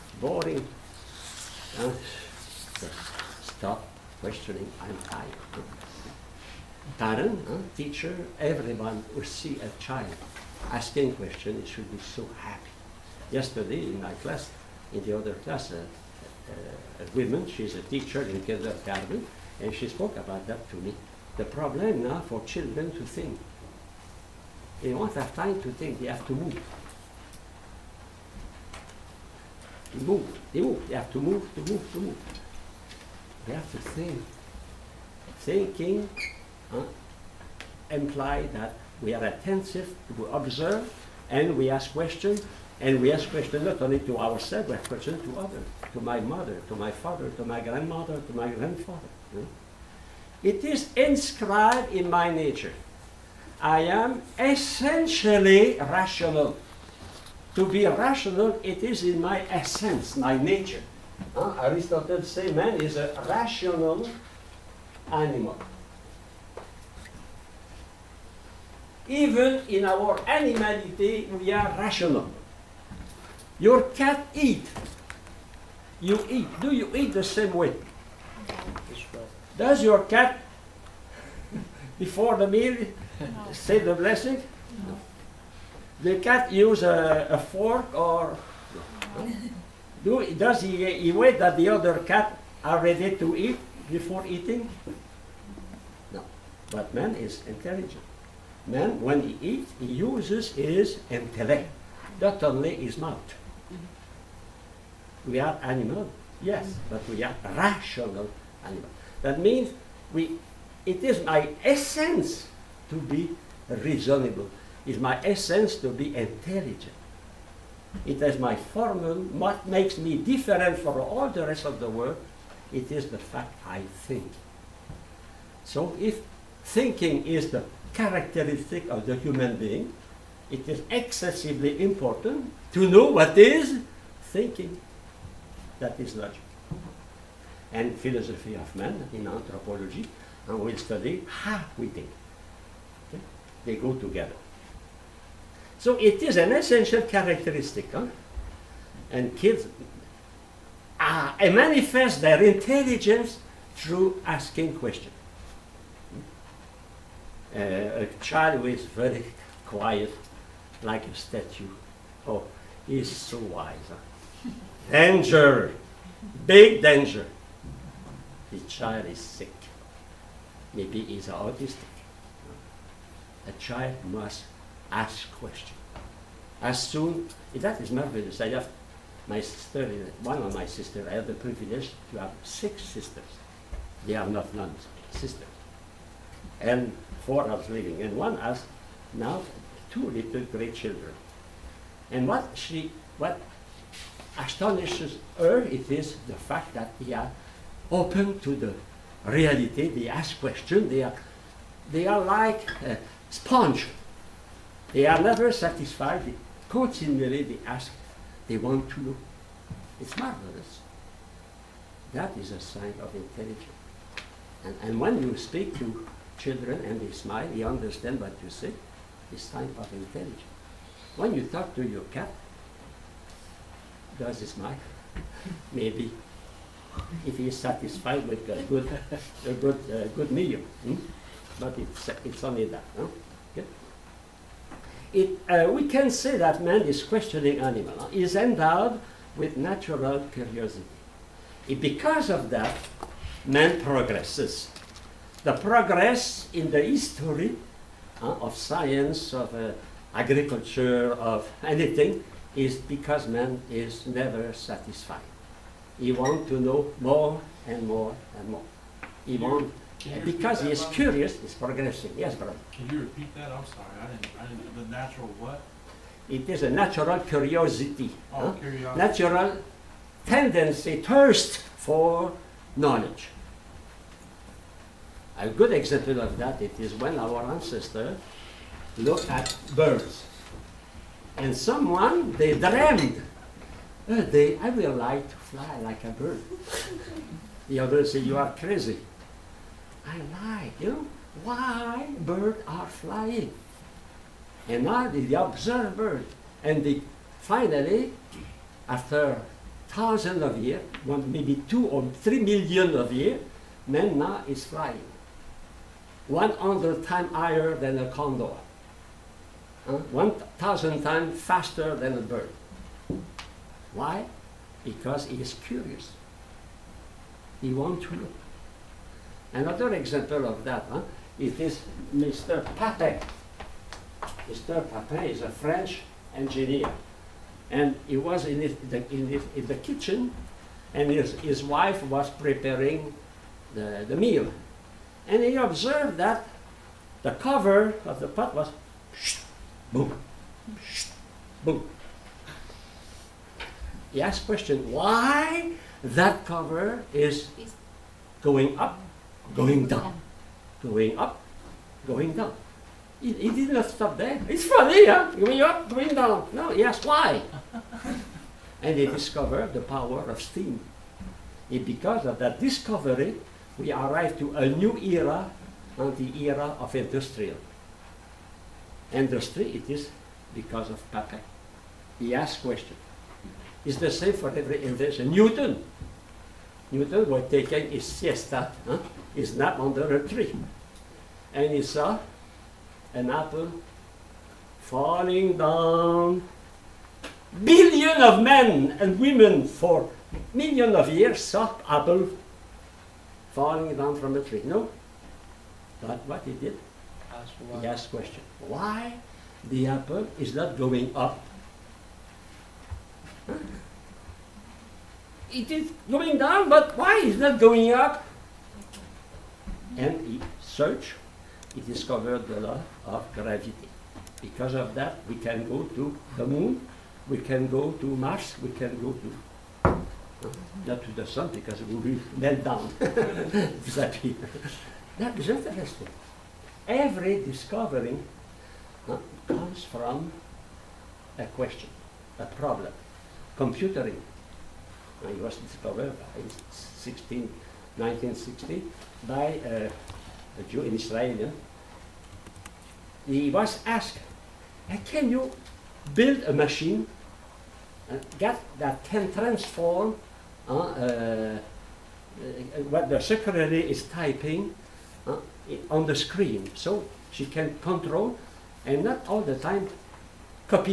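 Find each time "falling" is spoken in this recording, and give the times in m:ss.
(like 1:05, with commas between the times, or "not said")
6:24, 6:33.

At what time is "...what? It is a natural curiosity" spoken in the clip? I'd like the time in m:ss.
4:25.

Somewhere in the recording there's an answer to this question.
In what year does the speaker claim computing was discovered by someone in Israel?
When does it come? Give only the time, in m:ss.
7:17.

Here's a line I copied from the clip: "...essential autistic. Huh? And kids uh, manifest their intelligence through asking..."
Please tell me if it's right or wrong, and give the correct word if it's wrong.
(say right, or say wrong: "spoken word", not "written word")
wrong: "characteristic", not "autistic".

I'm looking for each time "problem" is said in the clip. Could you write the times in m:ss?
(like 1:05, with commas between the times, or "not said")
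0:21, 7:12.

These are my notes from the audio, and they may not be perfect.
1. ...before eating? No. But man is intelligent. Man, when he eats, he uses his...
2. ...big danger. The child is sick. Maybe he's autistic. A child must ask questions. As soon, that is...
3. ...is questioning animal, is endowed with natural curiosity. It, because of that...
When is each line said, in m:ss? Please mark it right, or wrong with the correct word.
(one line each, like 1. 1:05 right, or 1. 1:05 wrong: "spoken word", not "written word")
1. 1:33 right
2. 2:46 right
3. 3:56 right.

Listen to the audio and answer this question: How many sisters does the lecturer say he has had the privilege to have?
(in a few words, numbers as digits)
6.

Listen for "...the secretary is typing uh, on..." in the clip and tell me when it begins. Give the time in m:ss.
7:33.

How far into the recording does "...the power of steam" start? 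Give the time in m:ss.
5:59.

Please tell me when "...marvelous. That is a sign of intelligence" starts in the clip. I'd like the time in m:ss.
3:30.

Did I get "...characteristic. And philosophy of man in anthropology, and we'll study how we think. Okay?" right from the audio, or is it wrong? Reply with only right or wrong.
wrong.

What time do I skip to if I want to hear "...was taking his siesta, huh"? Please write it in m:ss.
6:17.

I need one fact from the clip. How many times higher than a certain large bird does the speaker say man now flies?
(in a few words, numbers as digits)
100.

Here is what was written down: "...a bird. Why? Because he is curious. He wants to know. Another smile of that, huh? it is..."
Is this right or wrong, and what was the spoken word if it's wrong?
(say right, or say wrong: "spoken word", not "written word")
wrong: "example", not "smile".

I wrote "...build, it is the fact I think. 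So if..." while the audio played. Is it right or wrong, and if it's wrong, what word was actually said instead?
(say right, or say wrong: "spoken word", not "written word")
wrong: "world", not "build".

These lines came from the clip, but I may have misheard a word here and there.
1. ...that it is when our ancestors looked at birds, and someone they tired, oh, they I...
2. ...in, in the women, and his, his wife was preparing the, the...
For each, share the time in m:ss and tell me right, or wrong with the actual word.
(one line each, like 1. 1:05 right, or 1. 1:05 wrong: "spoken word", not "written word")
1. 4:36 wrong: "dreamed", not "tired"
2. 5:29 wrong: "kitchen", not "women".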